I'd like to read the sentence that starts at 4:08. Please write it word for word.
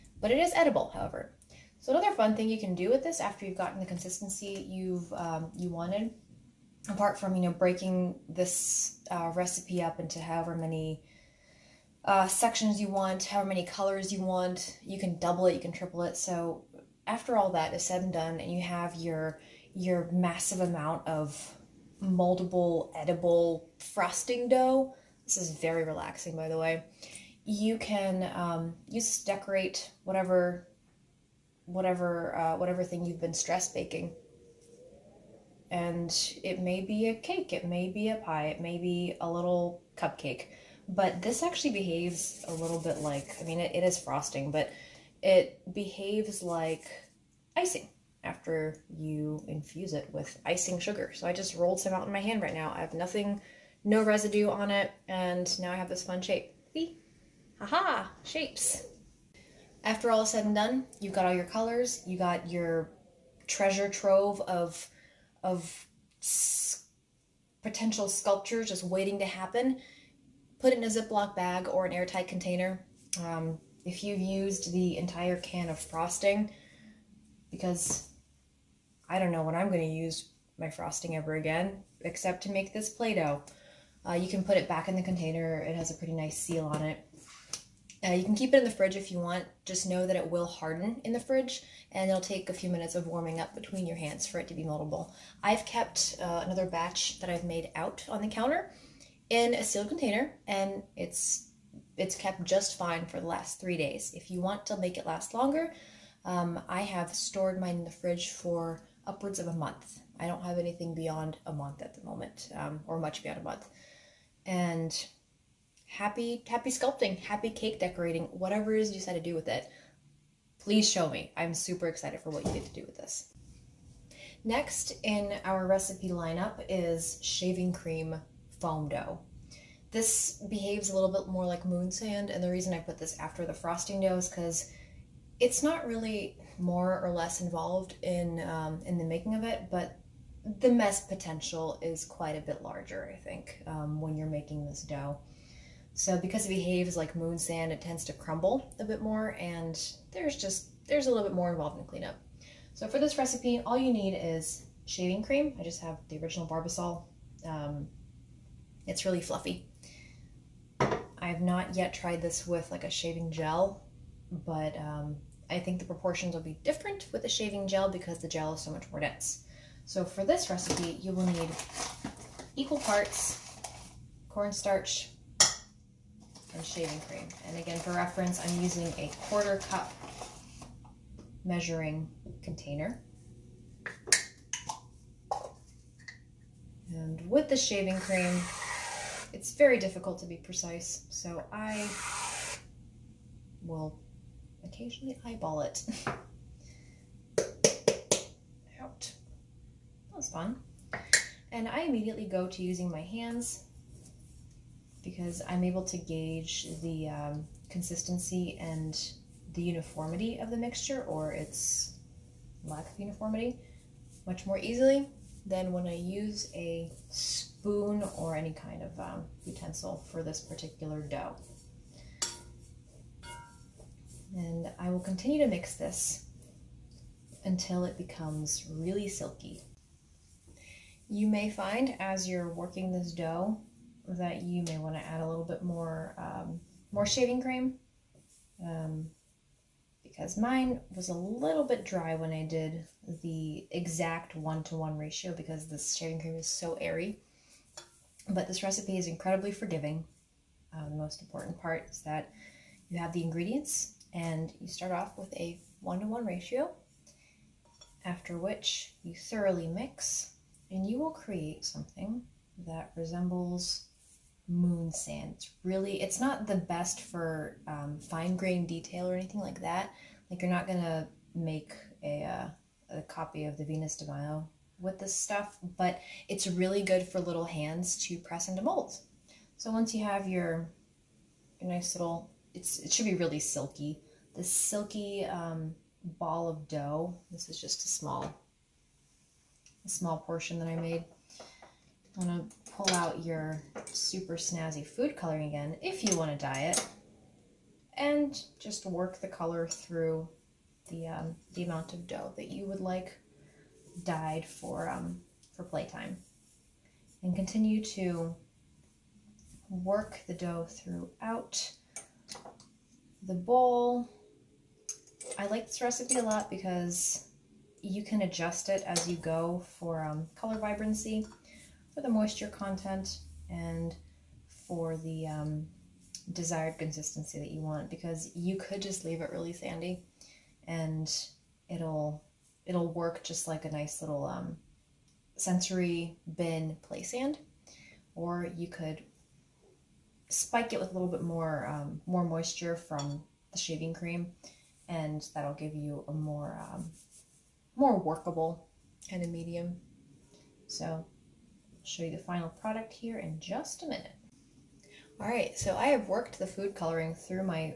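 But this recipe is incredibly forgiving.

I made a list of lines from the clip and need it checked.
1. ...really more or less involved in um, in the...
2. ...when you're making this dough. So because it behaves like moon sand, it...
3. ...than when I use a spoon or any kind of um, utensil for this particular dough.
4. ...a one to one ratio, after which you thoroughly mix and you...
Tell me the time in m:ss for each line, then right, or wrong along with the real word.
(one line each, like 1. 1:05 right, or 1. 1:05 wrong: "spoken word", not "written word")
1. 2:15 right
2. 2:24 right
3. 3:35 right
4. 4:15 right.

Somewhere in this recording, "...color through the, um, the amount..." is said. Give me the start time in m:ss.
4:59.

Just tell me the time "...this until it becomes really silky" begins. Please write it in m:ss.
3:45.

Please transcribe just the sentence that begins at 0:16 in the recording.
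So after all that is said and done, and you have your your massive amount of moldable, edible frosting dough.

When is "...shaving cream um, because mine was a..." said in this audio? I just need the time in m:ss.
3:57.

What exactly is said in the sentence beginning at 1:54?
And happy, happy sculpting, happy cake decorating, whatever it is you decide to do with it.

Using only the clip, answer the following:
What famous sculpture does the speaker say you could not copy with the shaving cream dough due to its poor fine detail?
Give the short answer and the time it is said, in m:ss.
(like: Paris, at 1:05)
Venus de Milo, at 4:33.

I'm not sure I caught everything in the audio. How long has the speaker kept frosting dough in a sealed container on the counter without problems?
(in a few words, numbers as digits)
3 days.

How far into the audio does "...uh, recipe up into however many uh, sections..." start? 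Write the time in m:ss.
0:09.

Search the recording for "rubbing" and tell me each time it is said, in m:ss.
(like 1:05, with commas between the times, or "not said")
not said.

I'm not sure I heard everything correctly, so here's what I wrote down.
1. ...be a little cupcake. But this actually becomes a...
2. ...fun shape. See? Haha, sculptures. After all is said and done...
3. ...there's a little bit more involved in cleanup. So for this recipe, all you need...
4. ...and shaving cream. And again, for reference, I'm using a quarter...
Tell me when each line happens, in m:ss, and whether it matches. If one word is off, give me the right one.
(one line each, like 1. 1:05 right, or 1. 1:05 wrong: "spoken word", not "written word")
1. 0:38 wrong: "behaves", not "becomes"
2. 0:56 wrong: "shapes", not "sculptures"
3. 2:30 right
4. 2:56 right.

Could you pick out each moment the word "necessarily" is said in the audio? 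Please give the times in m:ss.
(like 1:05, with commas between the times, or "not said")
not said.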